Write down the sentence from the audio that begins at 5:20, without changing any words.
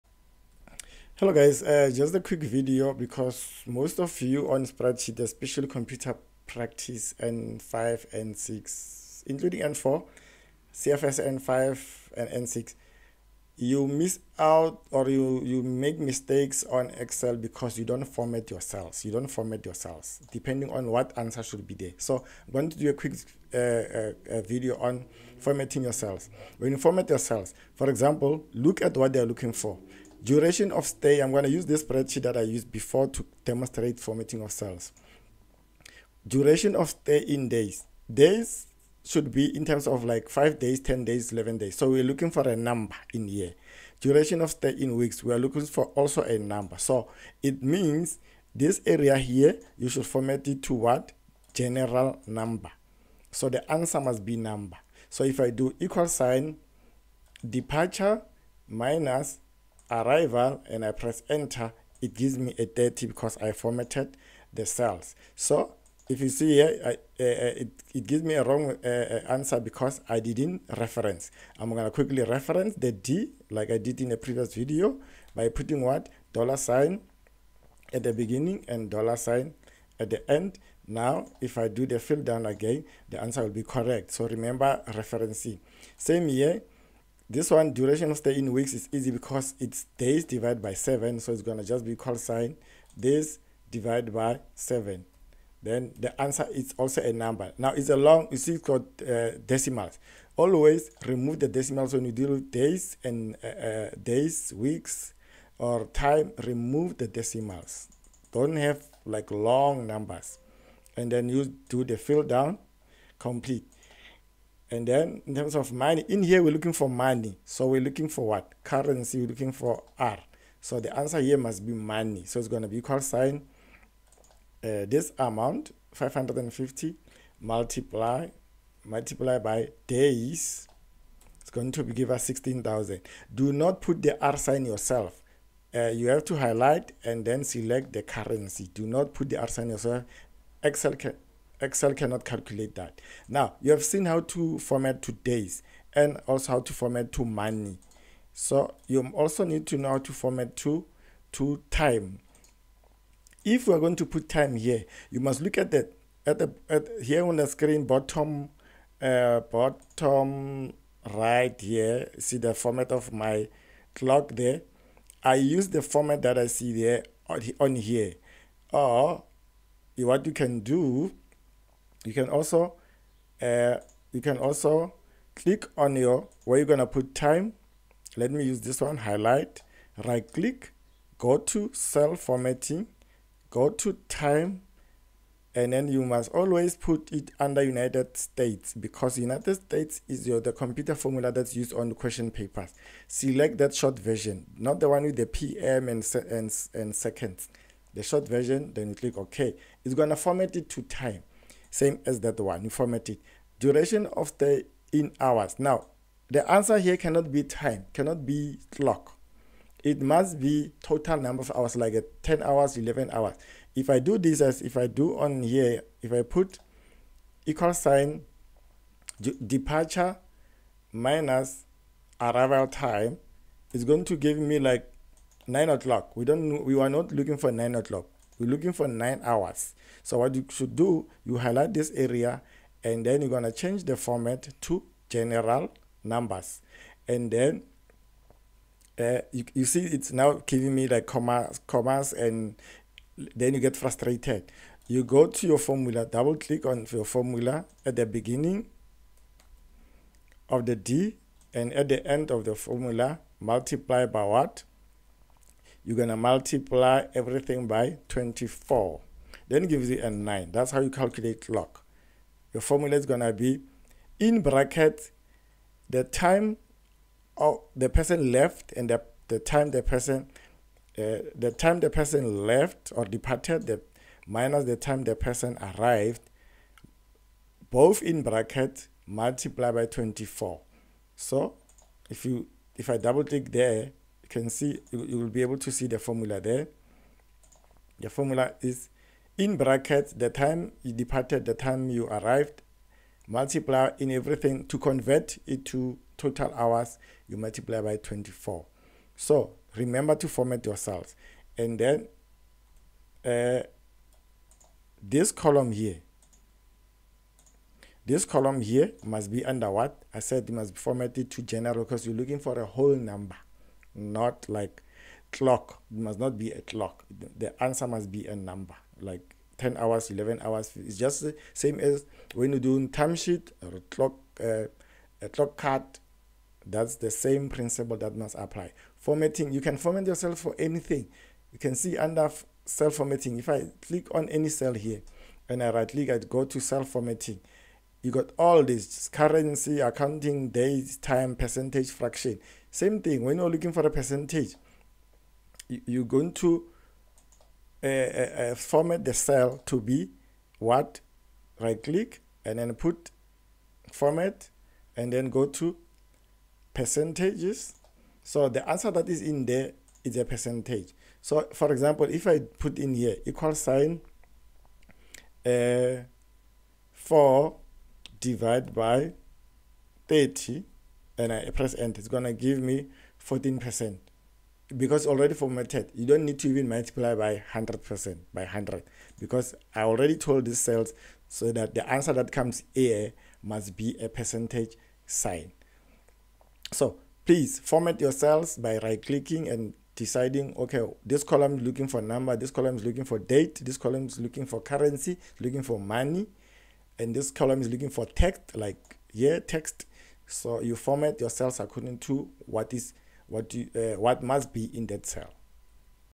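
It's just the same as when you do time sheet or a clock, uh, a clock card.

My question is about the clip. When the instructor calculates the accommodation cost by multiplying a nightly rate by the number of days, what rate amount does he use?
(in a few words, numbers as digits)
550.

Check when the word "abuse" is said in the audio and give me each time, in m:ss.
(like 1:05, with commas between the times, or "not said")
not said.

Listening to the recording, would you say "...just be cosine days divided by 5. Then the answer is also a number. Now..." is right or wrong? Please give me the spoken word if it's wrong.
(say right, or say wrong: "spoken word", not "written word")
wrong: "7", not "5".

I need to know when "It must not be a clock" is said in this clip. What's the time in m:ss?
5:15.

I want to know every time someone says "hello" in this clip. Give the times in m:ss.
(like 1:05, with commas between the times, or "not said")
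0:01.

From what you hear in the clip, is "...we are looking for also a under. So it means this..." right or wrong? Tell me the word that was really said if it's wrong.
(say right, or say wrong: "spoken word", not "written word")
wrong: "number", not "under".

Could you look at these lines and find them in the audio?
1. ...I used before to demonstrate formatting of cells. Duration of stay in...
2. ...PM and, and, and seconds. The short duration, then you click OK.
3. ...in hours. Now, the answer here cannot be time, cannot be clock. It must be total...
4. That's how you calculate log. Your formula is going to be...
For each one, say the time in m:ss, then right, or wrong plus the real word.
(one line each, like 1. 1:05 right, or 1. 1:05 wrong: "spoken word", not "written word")
1. 0:32 right
2. 3:15 wrong: "version", not "duration"
3. 3:24 right
4. 4:20 right.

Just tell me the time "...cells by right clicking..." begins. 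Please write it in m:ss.
6:28.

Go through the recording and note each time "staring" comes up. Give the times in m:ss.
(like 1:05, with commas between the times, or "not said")
not said.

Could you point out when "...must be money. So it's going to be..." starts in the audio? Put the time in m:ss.
2:01.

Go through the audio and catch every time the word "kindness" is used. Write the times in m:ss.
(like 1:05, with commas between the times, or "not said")
not said.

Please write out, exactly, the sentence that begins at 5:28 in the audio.
Formatting, you can format yourself for anything.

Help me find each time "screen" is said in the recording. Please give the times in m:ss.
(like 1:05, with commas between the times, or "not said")
2:37.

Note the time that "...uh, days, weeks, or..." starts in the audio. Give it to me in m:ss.
1:43.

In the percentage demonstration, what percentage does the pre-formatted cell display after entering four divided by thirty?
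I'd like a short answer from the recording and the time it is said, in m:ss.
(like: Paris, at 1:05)
14%, at 6:13.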